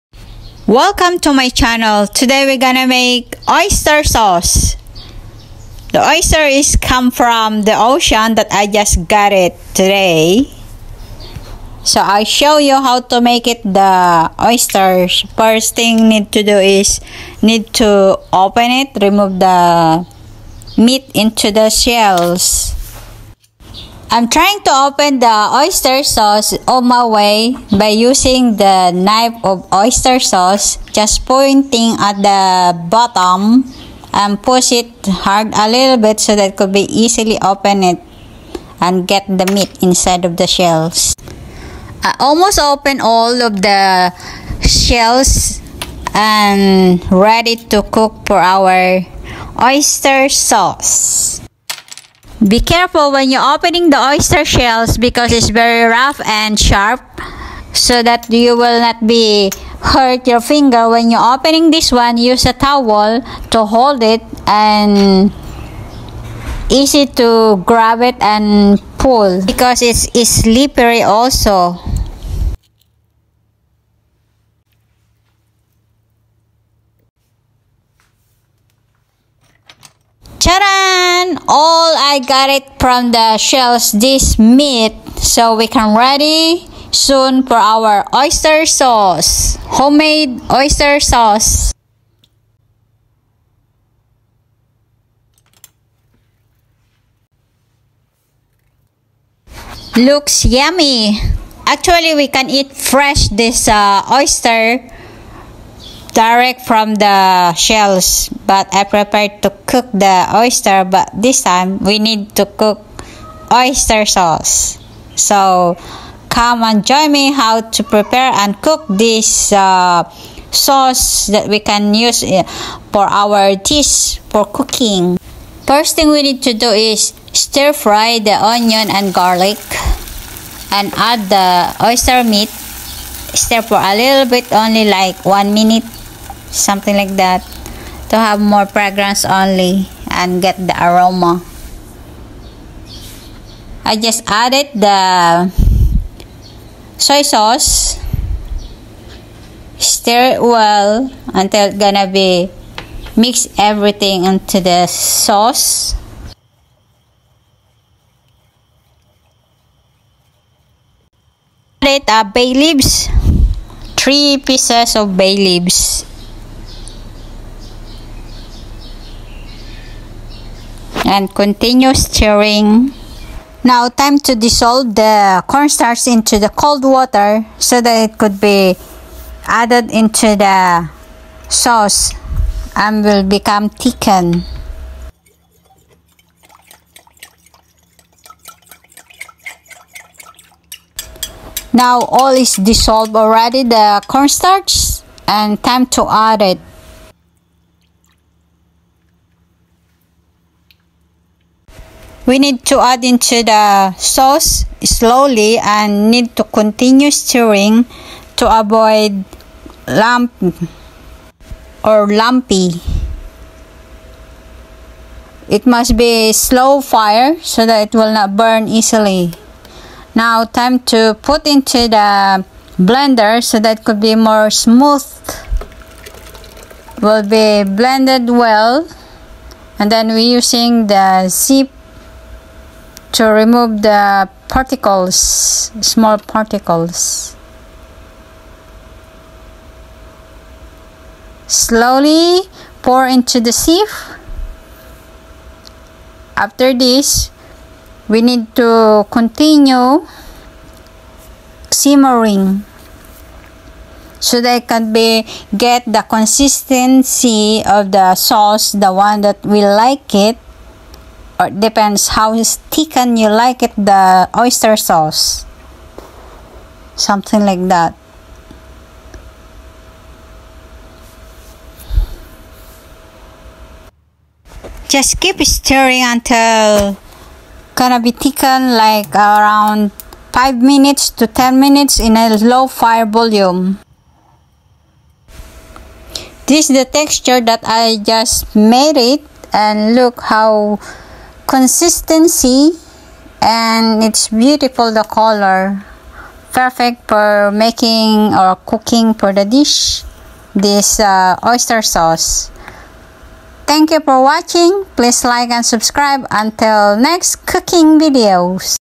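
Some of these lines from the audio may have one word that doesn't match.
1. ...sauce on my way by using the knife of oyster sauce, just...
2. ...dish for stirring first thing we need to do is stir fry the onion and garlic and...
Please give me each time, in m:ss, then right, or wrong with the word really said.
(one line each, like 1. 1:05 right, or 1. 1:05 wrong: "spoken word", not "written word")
1. 0:26 right
2. 2:03 wrong: "cooking", not "stirring".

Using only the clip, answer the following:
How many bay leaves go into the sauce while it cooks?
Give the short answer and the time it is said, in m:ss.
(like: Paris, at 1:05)
3, at 2:43.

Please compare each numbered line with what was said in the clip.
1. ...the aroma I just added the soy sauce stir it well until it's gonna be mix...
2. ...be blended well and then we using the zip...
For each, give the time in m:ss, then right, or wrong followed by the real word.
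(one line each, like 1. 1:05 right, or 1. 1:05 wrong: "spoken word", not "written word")
1. 2:20 right
2. 3:47 right.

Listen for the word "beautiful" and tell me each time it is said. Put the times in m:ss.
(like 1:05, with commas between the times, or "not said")
4:54.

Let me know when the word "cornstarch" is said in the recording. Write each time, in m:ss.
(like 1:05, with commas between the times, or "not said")
2:55, 3:14.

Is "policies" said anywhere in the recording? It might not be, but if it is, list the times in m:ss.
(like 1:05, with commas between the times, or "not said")
not said.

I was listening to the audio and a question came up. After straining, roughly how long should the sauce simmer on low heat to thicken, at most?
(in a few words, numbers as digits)
10 minutes.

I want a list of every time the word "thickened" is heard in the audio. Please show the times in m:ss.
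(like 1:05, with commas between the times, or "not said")
3:03, 4:38.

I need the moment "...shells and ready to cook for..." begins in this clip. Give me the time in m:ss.
0:44.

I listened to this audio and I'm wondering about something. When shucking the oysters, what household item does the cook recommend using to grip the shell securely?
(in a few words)
A towel.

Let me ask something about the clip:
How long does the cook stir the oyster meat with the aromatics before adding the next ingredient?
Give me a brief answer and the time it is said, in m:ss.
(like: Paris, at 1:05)
1 minute, at 2:15.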